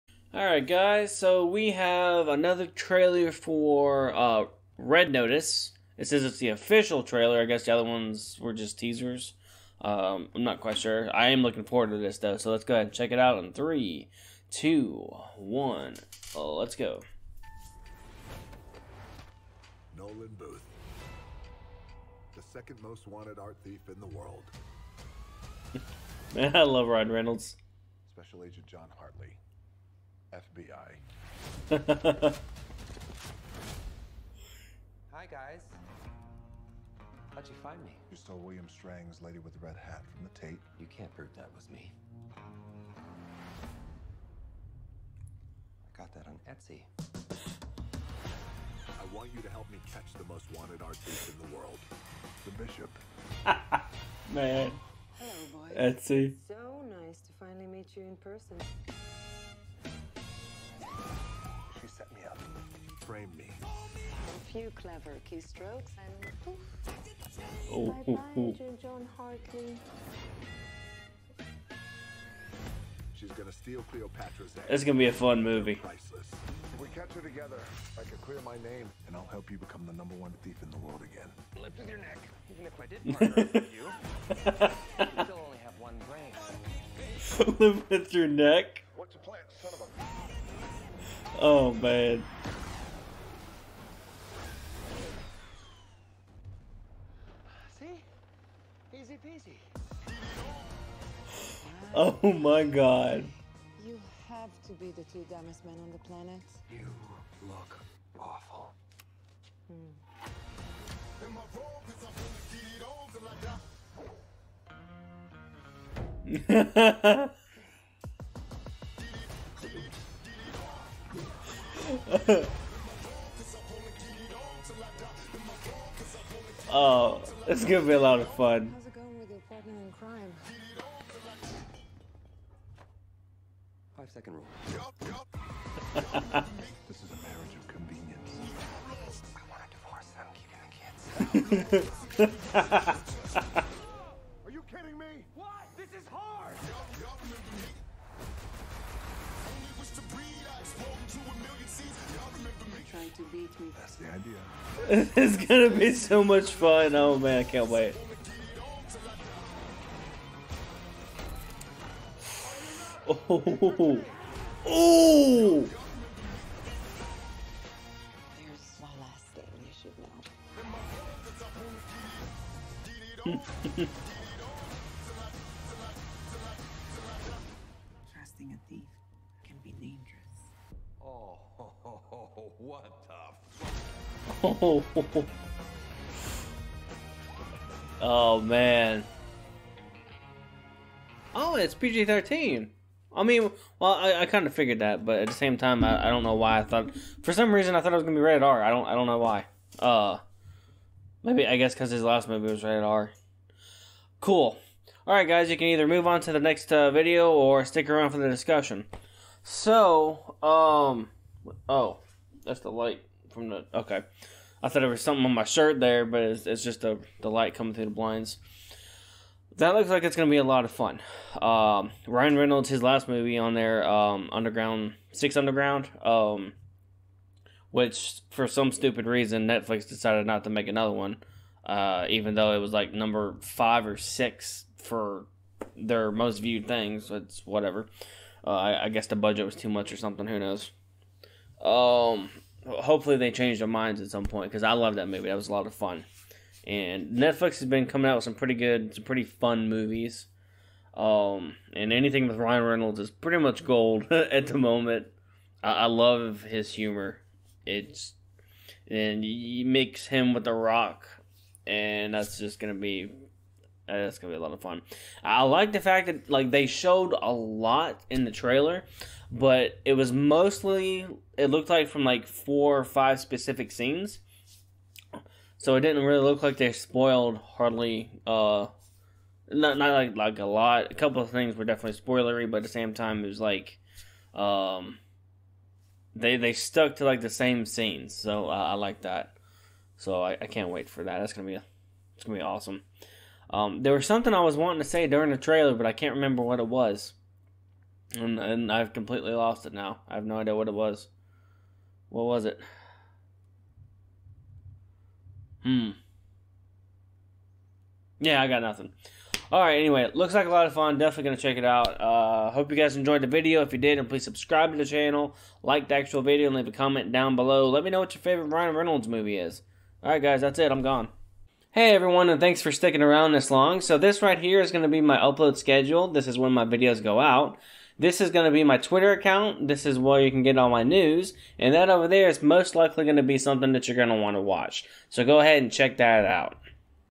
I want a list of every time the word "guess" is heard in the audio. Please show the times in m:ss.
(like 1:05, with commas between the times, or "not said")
0:07, 3:21, 3:58.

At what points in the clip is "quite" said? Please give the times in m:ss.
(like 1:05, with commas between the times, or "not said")
0:10.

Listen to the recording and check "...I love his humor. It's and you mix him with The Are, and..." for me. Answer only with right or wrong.
wrong.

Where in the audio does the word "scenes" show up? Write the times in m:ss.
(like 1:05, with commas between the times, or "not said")
4:33, 4:47.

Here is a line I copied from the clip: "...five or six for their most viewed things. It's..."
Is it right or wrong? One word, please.
right.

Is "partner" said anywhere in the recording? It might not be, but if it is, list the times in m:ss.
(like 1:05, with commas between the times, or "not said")
1:23.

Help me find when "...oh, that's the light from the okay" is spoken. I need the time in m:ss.
3:31.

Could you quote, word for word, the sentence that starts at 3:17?
For some reason, I thought it was gonna be rated R.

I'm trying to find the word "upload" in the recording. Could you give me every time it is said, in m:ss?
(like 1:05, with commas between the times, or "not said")
5:25.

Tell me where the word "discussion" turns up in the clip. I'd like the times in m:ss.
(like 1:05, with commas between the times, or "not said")
3:28.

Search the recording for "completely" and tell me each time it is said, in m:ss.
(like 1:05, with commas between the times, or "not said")
4:58.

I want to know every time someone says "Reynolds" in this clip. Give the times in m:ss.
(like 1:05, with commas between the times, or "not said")
0:27, 3:42, 4:12, 5:18.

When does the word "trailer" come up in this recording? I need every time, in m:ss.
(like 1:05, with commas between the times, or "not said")
0:02, 0:07, 4:28, 4:55.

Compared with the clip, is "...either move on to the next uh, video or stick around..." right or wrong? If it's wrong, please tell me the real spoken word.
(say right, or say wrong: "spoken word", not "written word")
right.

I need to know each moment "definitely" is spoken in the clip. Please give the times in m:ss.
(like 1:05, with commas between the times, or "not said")
4:41, 5:10.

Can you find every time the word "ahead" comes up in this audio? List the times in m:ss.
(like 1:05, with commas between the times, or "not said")
0:12, 5:35.